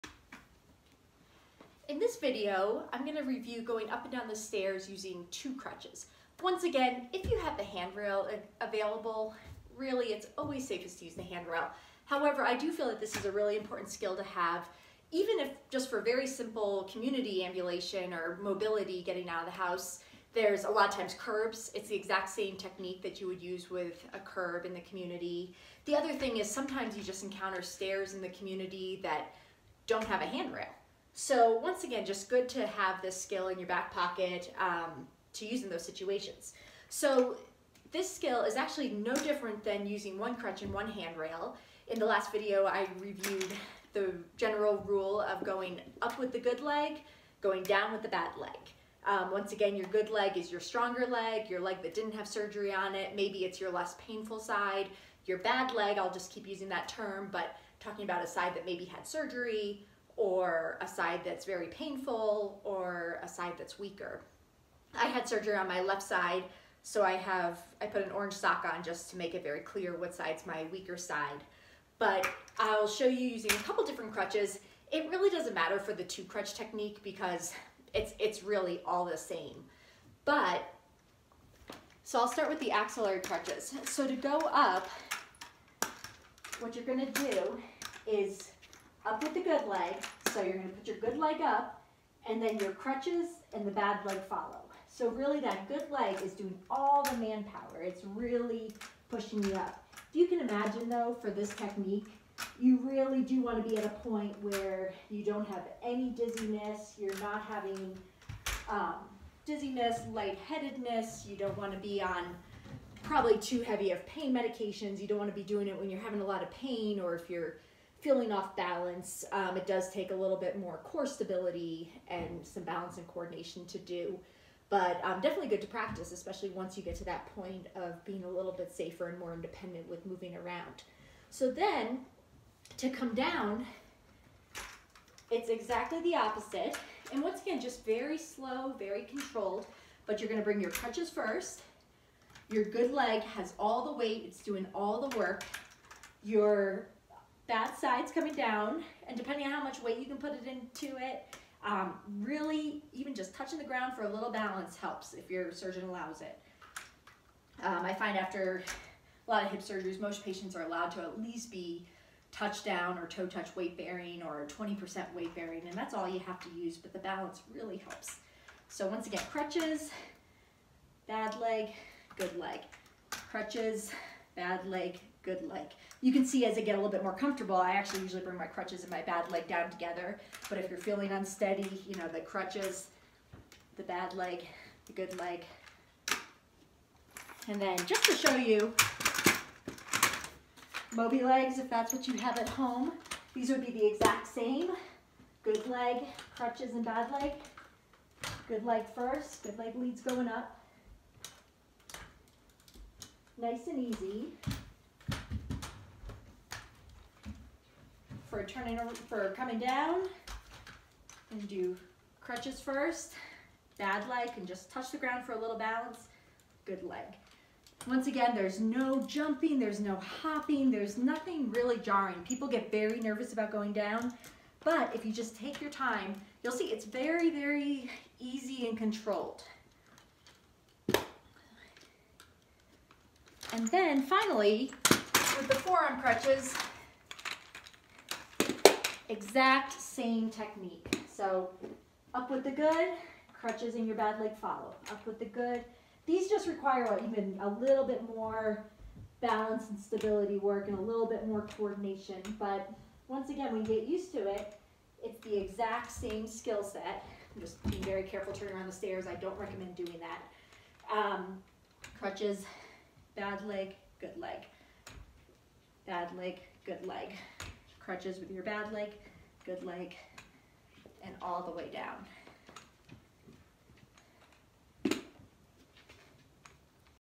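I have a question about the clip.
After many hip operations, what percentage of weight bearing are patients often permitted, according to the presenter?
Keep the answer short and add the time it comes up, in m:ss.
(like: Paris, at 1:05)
20%, at 2:44.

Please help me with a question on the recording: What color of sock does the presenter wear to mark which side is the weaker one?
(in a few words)
Orange.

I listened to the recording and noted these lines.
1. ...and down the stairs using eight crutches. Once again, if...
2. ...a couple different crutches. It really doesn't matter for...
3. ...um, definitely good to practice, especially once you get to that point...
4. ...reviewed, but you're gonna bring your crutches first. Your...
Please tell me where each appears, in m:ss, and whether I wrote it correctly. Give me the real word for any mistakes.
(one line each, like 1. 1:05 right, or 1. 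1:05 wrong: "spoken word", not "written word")
1. 0:04 wrong: "two", not "eight"
2. 1:13 right
3. 2:05 right
4. 2:19 wrong: "controlled", not "reviewed".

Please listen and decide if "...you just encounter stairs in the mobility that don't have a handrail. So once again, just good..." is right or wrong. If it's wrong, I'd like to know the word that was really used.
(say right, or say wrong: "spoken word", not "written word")
wrong: "community", not "mobility".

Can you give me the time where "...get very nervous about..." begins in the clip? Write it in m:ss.
3:42.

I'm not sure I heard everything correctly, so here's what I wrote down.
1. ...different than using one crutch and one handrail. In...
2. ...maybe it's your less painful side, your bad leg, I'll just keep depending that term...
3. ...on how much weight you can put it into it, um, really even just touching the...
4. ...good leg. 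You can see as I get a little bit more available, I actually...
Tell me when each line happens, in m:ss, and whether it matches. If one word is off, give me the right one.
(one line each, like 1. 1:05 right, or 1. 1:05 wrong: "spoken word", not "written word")
1. 0:39 right
2. 0:53 wrong: "using", not "depending"
3. 2:29 right
4. 2:55 wrong: "comfortable", not "available".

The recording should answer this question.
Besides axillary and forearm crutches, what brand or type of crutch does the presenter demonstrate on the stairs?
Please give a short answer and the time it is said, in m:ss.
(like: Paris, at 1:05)
Mobilegs, at 3:10.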